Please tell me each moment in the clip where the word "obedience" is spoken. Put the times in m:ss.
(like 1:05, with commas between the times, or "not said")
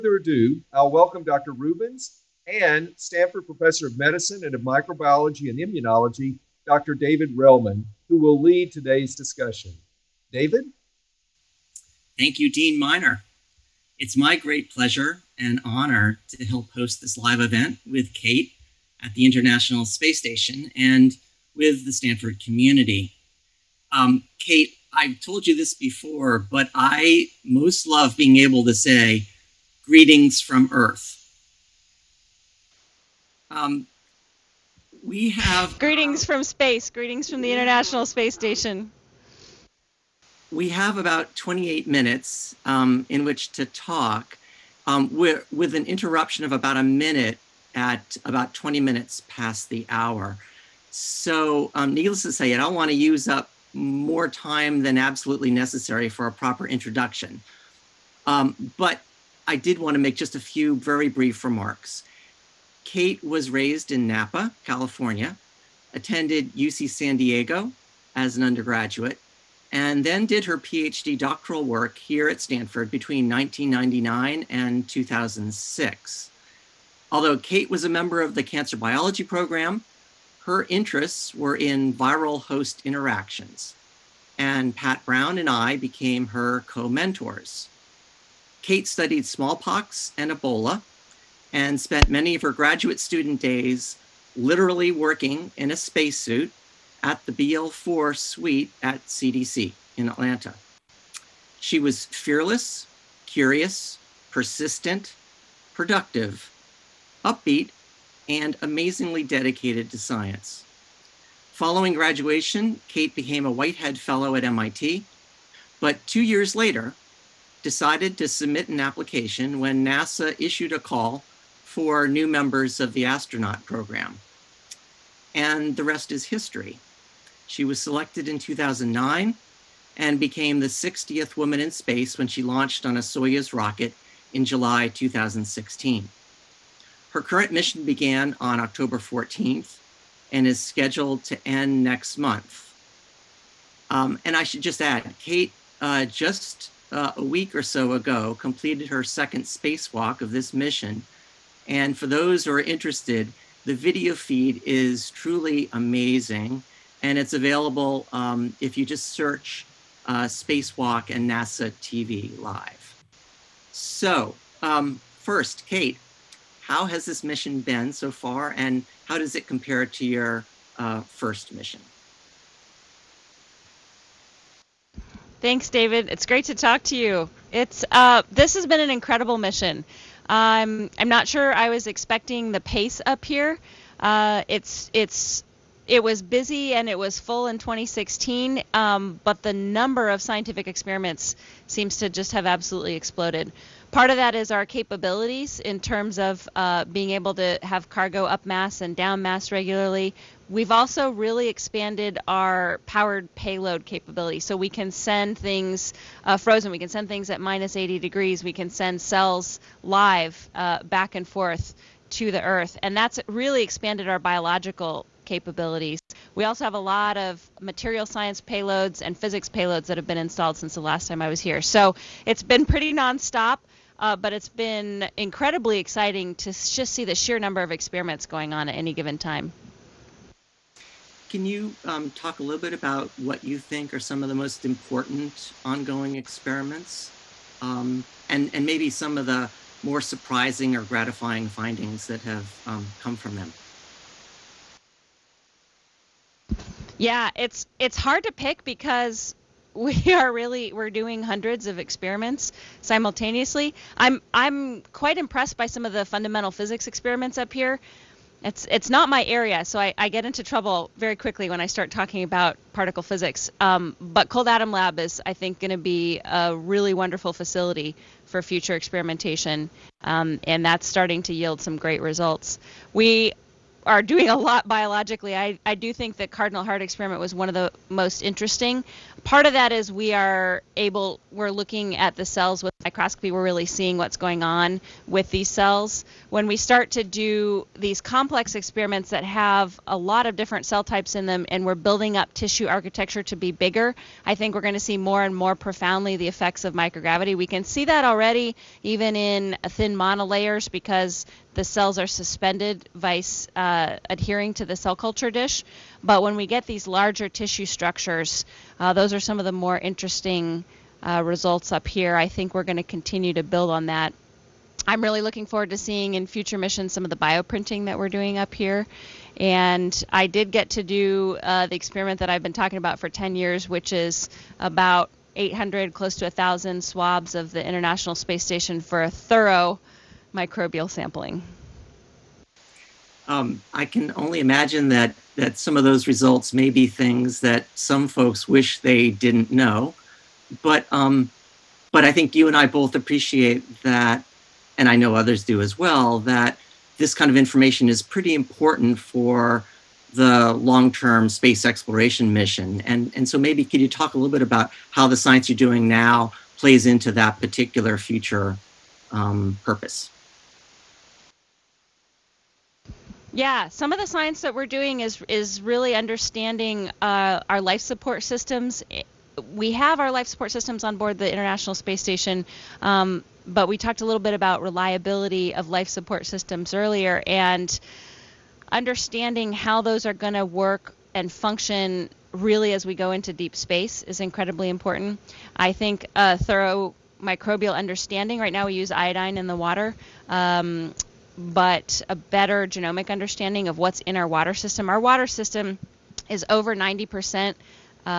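not said.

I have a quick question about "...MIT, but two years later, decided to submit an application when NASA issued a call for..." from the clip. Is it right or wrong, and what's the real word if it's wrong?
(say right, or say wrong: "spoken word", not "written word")
right.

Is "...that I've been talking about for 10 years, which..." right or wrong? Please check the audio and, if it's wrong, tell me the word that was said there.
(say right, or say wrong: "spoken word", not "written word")
right.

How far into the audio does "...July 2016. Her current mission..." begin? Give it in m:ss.
2:14.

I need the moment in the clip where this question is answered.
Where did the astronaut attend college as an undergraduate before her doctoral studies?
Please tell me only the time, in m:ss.
1:06.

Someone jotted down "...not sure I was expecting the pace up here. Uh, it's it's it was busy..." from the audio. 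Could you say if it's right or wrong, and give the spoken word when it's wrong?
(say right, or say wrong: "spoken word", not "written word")
right.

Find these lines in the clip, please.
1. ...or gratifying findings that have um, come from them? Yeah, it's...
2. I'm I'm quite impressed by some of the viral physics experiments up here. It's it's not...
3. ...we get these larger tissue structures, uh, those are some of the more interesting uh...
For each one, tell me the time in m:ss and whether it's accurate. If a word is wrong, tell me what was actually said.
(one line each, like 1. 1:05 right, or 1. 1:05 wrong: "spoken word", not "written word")
1. 4:00 right
2. 4:13 wrong: "fundamental", not "viral"
3. 5:06 right.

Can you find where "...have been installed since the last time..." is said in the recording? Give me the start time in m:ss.
3:39.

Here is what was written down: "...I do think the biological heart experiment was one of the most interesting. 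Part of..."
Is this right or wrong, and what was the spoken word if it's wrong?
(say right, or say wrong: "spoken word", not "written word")
wrong: "cardinal", not "biological".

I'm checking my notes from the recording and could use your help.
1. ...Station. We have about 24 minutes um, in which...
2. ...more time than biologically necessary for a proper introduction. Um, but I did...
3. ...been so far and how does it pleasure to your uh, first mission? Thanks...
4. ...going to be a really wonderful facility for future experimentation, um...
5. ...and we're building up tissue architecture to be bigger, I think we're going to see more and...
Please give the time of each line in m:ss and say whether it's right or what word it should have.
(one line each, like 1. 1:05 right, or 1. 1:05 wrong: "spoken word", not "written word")
1. 0:38 wrong: "28", not "24"
2. 0:53 wrong: "absolutely", not "biologically"
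3. 2:47 wrong: "compare", not "pleasure"
4. 4:25 right
5. 4:51 right.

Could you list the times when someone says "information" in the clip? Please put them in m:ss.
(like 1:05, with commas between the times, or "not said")
5:47.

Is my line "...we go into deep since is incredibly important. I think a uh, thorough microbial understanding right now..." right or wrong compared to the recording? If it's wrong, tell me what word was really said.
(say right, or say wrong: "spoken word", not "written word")
wrong: "space", not "since".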